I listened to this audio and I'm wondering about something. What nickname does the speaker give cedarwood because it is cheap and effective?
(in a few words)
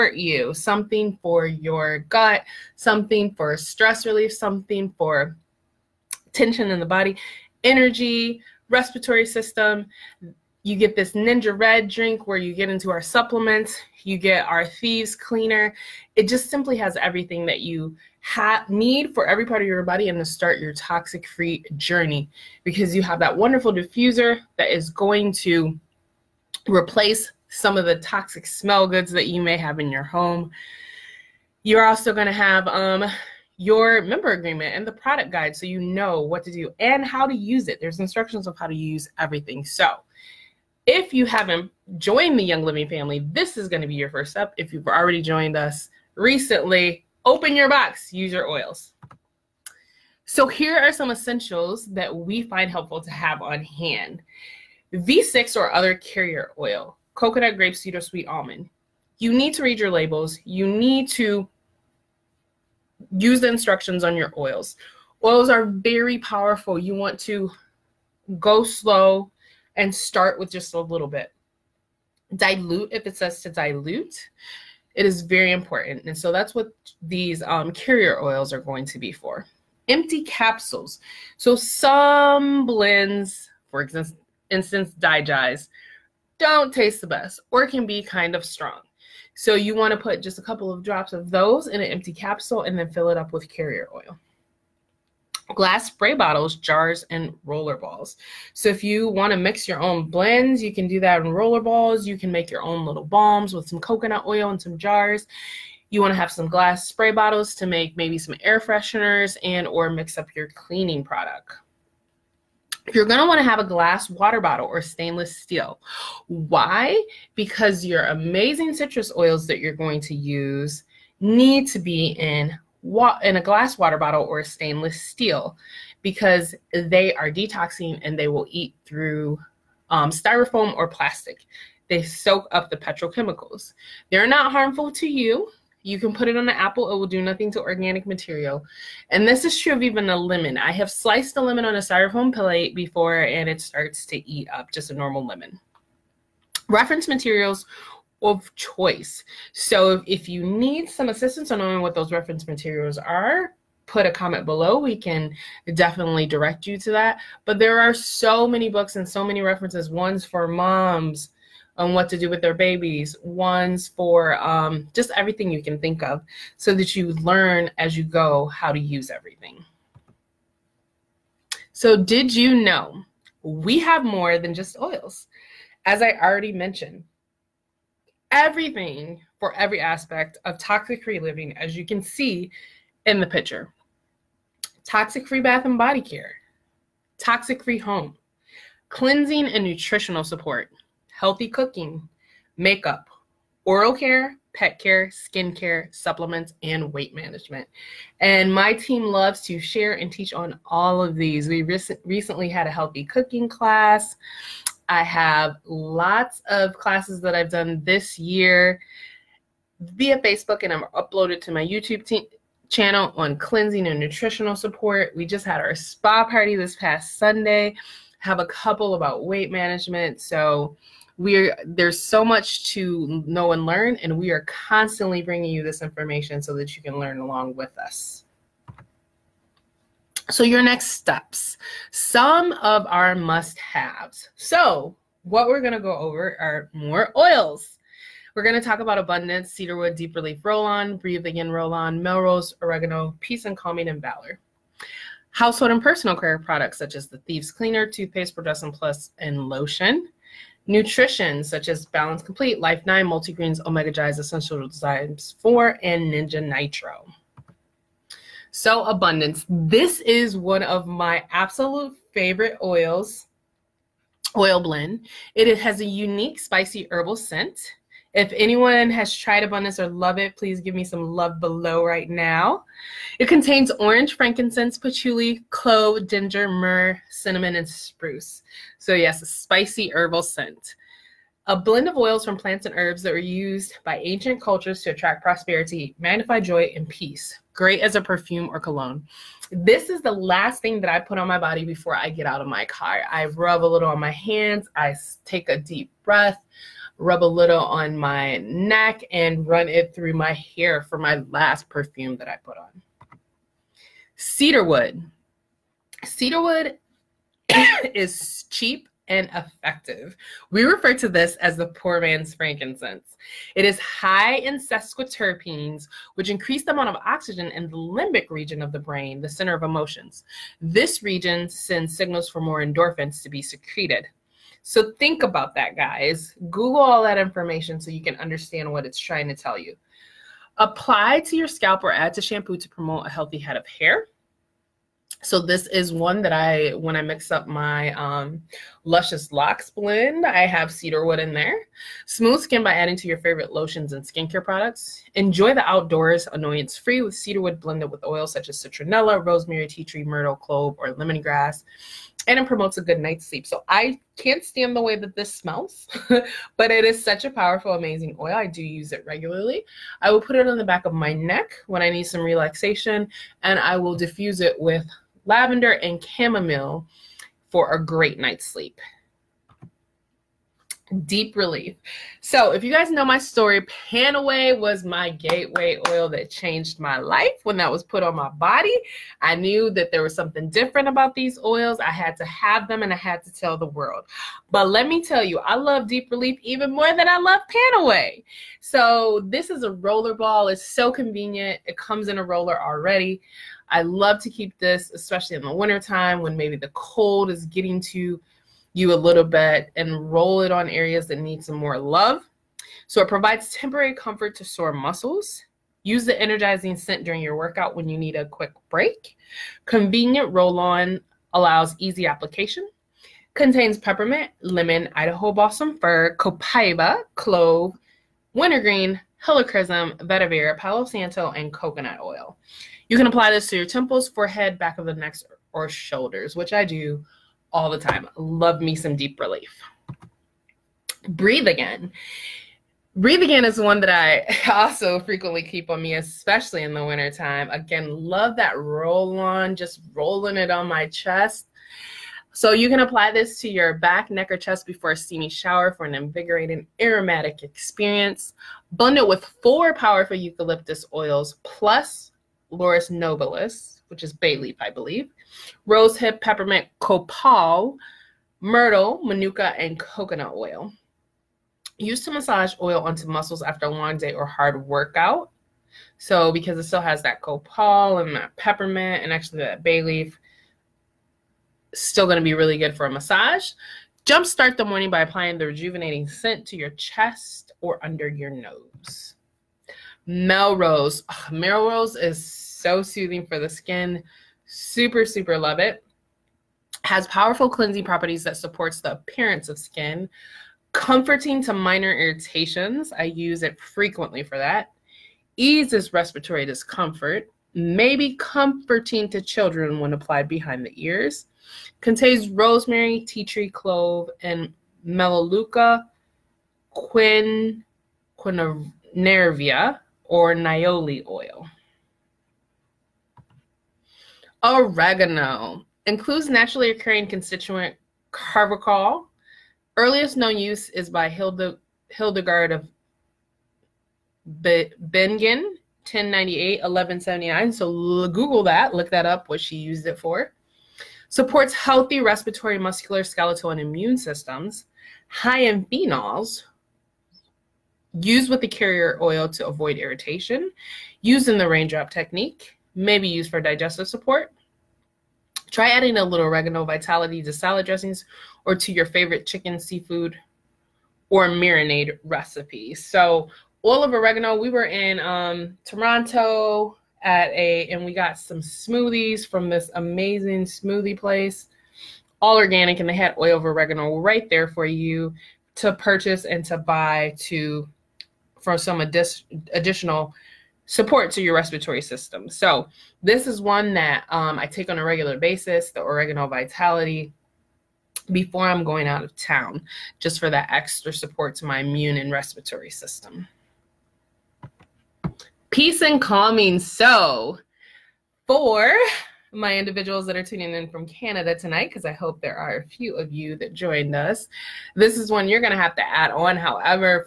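Poor man's frankincense.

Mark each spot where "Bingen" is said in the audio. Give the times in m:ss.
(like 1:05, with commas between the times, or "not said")
8:44.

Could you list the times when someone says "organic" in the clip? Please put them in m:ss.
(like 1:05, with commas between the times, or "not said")
2:17, 9:22.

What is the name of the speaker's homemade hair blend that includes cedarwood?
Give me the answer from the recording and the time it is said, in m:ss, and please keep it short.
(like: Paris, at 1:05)
Luscious Locks, at 5:38.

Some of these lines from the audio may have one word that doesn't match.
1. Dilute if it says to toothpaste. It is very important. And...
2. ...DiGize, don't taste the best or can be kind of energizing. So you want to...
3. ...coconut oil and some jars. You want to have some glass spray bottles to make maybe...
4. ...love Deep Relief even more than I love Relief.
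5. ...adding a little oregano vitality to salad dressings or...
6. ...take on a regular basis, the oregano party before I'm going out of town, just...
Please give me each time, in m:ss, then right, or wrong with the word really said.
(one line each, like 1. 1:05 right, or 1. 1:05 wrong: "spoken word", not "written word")
1. 1:12 wrong: "dilute", not "toothpaste"
2. 1:24 wrong: "strong", not "energizing"
3. 1:43 right
4. 6:25 wrong: "Panaway", not "Relief"
5. 9:05 right
6. 9:34 wrong: "vitality", not "party".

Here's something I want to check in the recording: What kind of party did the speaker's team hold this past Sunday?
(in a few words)
Spa party.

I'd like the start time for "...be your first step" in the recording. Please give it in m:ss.
0:43.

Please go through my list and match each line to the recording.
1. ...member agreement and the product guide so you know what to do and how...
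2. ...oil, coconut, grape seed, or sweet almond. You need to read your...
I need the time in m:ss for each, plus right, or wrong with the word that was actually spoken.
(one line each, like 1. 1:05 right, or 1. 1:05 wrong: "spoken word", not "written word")
1. 0:34 right
2. 0:56 right.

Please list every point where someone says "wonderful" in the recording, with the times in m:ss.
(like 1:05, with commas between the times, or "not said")
0:23.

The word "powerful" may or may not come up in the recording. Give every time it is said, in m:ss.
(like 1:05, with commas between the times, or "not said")
1:06, 5:57, 7:29, 8:07.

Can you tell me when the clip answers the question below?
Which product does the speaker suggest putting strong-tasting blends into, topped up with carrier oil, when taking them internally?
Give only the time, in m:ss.
1:19.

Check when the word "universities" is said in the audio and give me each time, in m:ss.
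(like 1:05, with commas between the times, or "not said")
not said.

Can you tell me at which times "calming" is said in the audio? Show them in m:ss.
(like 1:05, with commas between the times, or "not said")
4:03, 9:45.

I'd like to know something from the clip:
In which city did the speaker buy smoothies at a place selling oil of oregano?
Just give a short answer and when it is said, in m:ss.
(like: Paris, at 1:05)
Toronto, at 9:15.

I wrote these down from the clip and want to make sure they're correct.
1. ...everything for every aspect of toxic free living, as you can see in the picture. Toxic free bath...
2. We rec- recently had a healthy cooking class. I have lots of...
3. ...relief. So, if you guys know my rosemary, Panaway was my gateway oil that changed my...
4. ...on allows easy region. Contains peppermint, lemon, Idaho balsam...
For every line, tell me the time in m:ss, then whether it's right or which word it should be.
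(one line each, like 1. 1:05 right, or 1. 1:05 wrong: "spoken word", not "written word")
1. 2:58 right
2. 3:21 right
3. 6:11 wrong: "story", not "rosemary"
4. 6:50 wrong: "application", not "region".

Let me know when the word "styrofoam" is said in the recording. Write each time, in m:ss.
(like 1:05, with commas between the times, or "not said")
2:10, 2:21.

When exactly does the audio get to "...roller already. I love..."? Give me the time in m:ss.
6:32.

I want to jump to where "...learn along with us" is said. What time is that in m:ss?
3:46.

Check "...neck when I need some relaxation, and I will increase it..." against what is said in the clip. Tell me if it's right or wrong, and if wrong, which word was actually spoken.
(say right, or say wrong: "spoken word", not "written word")
wrong: "diffuse", not "increase".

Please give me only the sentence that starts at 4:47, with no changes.
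Great as a perfume or cologne.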